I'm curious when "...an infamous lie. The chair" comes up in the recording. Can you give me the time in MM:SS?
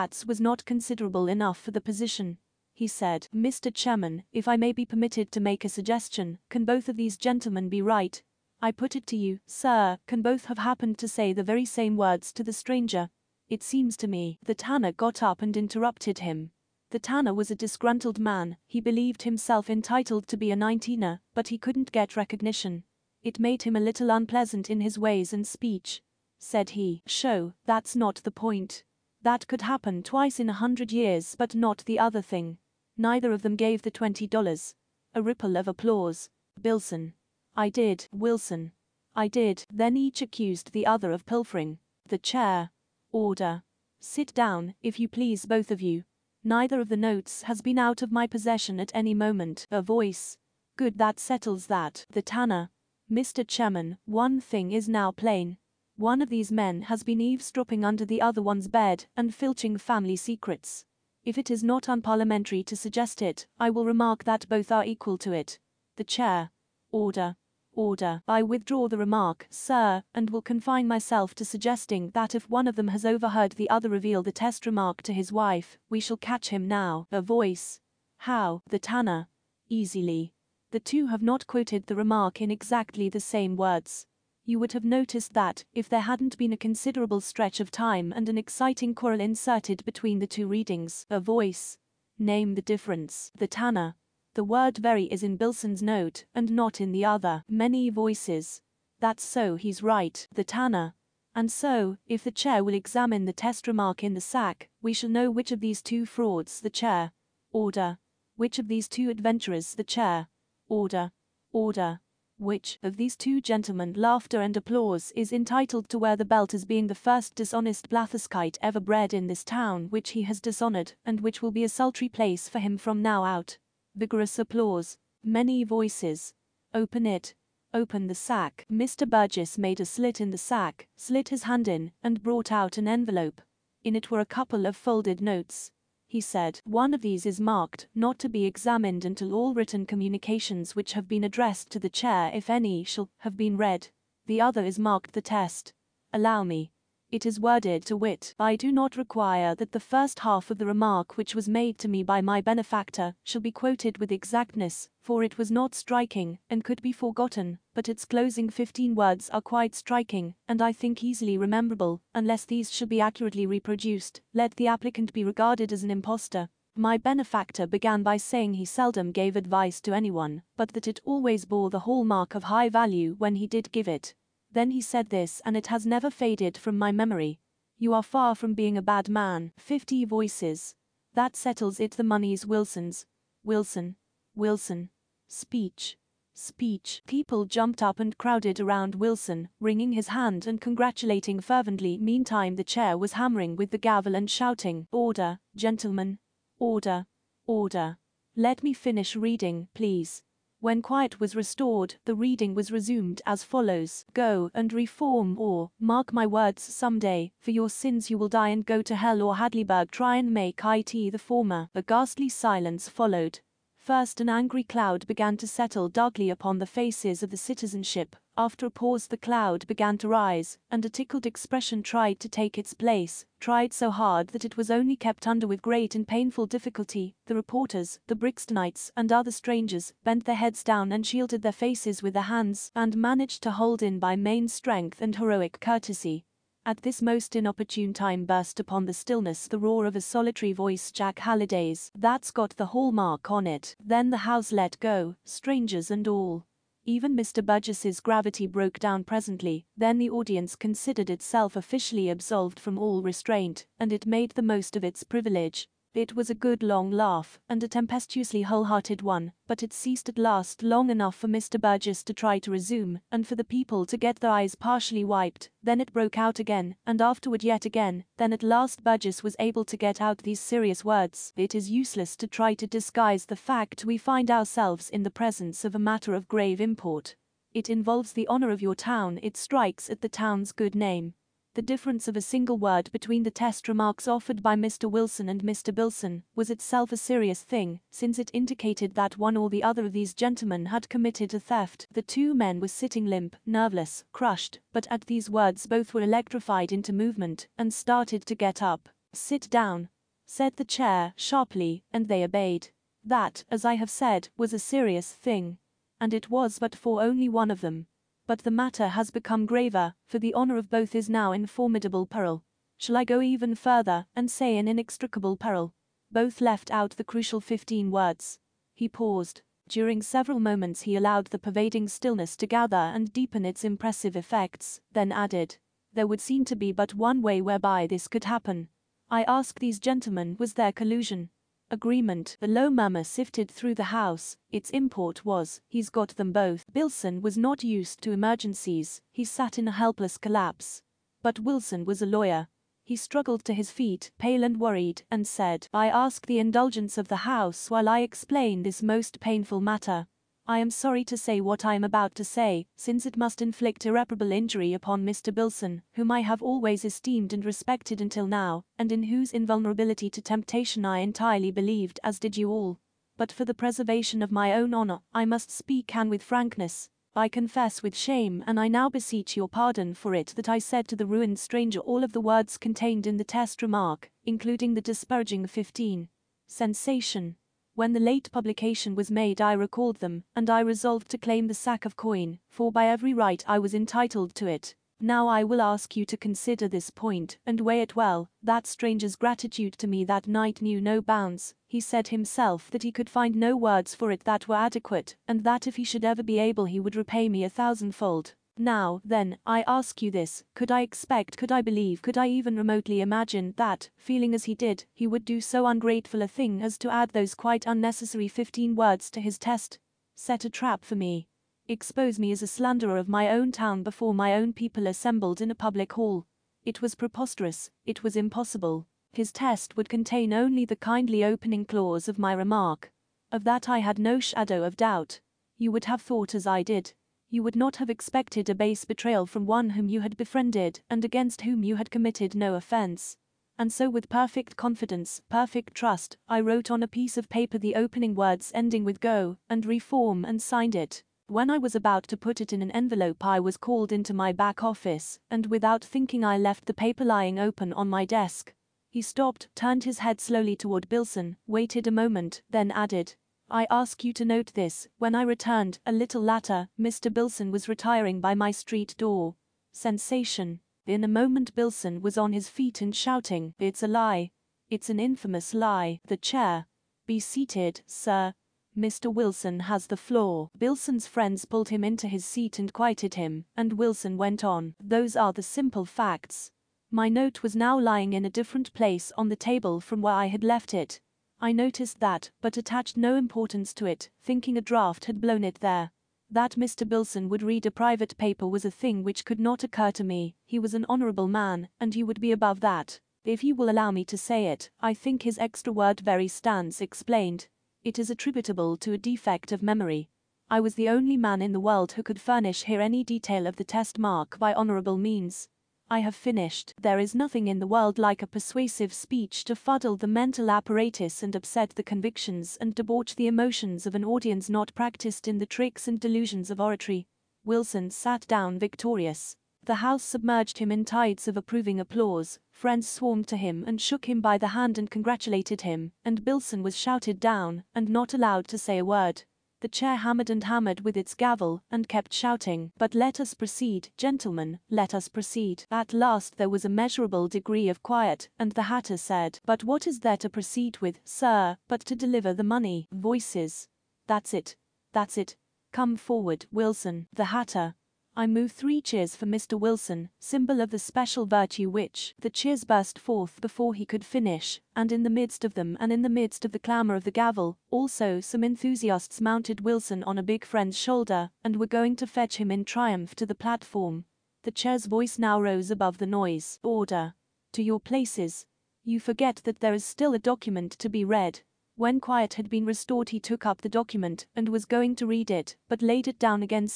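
07:44.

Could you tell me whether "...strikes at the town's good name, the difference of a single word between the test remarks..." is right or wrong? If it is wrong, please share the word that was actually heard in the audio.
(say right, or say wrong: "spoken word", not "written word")
right.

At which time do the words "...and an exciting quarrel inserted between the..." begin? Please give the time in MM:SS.
01:28.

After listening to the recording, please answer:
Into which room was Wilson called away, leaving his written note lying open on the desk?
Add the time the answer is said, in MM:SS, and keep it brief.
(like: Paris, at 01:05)
back office, at 07:24.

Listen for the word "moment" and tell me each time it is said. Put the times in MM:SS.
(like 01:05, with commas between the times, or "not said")
00:49, 05:20, 07:31, 07:41.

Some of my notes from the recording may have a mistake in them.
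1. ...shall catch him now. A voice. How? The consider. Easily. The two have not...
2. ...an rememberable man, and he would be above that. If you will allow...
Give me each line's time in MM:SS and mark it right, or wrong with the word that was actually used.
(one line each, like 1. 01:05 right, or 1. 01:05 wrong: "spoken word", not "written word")
1. 01:15 wrong: "tanner", not "consider"
2. 08:10 wrong: "honorable", not "rememberable".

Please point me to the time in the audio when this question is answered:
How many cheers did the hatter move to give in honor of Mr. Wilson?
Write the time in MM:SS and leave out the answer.
09:08.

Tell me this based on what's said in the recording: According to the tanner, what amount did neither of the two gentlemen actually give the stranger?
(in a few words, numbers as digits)
$20.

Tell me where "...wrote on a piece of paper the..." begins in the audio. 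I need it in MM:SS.
07:16.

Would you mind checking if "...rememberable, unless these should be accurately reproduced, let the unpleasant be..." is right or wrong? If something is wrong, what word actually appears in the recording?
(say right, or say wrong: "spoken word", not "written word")
wrong: "applicant", not "unpleasant".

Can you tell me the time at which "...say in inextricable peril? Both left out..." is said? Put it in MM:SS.
05:14.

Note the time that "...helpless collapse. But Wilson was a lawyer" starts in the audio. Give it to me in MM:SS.
05:39.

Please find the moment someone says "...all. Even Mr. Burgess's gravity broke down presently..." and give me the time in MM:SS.
04:06.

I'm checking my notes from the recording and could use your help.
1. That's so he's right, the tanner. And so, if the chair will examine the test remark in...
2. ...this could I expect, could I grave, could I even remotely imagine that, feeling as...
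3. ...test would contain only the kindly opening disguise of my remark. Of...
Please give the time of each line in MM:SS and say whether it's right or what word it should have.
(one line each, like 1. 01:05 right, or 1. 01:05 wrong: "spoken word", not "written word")
1. 01:38 right
2. 06:40 wrong: "believe", not "grave"
3. 06:59 wrong: "clause", not "disguise".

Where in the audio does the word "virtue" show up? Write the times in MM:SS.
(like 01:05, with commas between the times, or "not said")
09:11.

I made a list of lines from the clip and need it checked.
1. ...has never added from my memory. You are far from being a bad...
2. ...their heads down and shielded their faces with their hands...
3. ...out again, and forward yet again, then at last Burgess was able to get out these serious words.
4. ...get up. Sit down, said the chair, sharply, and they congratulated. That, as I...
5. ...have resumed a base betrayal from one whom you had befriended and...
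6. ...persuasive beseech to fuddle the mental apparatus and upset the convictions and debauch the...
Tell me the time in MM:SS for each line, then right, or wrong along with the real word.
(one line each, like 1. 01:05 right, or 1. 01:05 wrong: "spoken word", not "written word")
1. 02:55 wrong: "faded", not "added"
2. 03:50 right
3. 04:26 wrong: "afterward", not "forward"
4. 04:58 wrong: "obeyed", not "congratulated"
5. 07:07 wrong: "expected", not "resumed"
6. 08:28 wrong: "speech", not "beseech".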